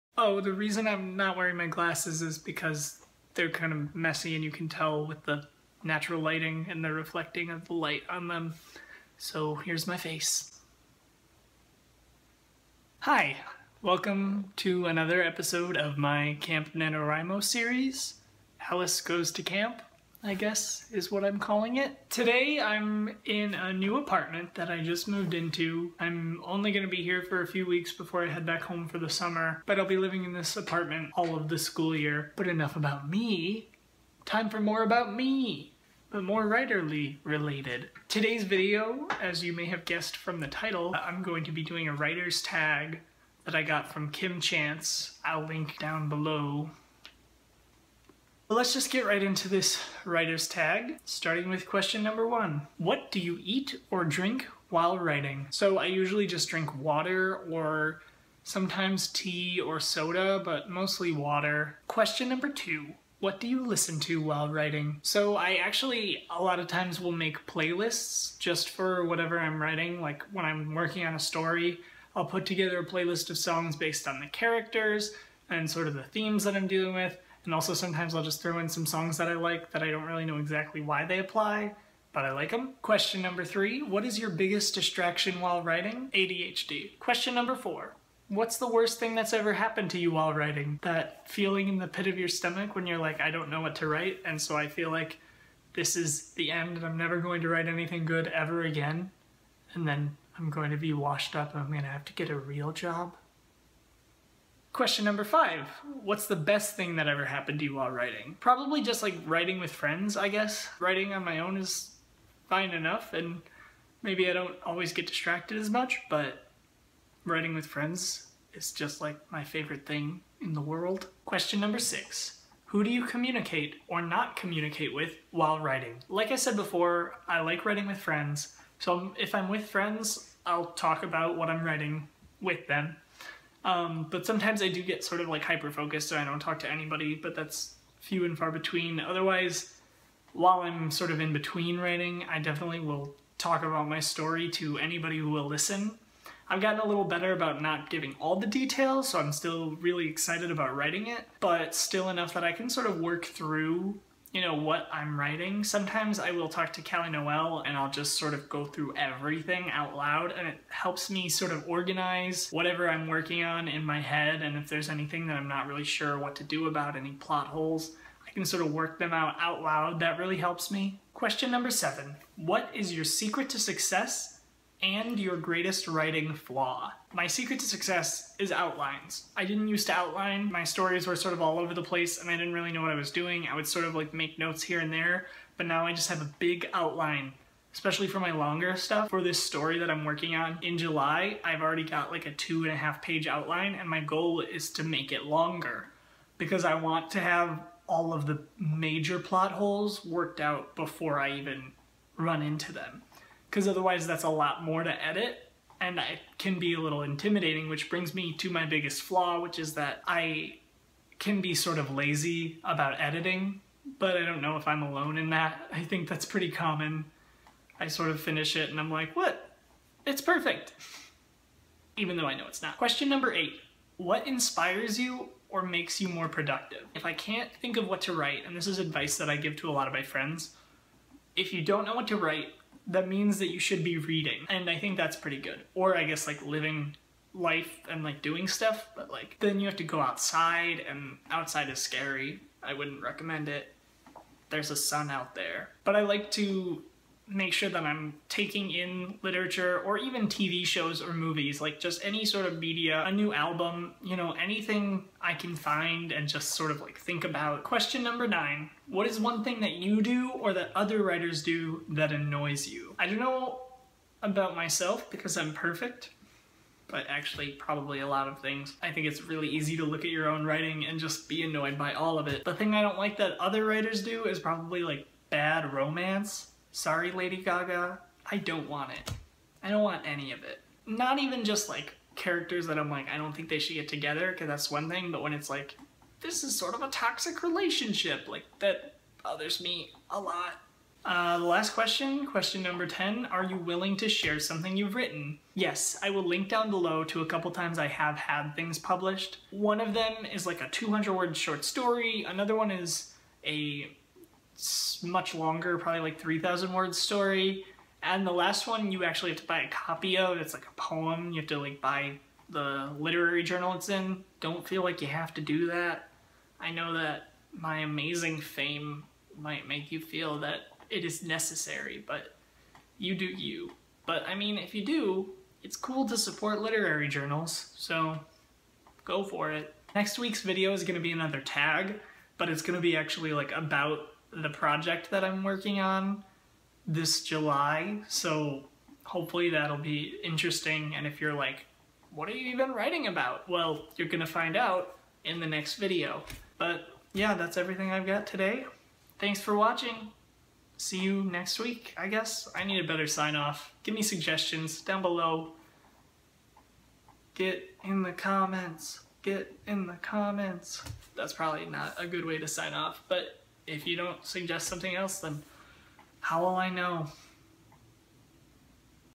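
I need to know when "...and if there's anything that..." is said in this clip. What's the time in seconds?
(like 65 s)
164 s.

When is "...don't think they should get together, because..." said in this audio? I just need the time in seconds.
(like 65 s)
283 s.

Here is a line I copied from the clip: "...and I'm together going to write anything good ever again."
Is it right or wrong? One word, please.
wrong.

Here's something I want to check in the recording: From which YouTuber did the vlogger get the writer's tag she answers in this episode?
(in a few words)
Kim Chance.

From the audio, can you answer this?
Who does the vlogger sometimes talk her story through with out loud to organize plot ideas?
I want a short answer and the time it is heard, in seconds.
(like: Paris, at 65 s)
Callie Noel, at 156 s.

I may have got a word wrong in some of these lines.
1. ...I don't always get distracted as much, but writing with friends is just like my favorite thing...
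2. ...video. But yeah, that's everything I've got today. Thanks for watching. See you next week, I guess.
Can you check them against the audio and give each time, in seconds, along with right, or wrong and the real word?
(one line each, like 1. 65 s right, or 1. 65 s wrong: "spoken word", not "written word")
1. 114 s right
2. 345 s right.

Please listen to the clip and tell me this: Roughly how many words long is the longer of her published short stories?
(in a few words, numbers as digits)
3,000 words.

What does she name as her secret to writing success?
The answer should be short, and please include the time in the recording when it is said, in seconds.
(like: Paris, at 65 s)
Outlines, at 178 s.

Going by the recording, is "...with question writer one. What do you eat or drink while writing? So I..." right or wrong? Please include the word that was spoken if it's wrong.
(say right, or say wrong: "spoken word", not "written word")
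wrong: "number", not "writer".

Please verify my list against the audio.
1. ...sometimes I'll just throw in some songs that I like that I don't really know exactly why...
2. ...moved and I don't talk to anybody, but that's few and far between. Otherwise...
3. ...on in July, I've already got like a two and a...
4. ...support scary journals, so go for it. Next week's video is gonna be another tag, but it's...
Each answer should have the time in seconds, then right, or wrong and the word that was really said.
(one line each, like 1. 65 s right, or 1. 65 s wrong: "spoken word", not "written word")
1. 77 s right
2. 135 s wrong: "focused", not "moved"
3. 190 s right
4. 326 s wrong: "literary", not "scary".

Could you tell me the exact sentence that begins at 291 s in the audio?
Uh, the last question, question number 10, are you willing to share something you've written?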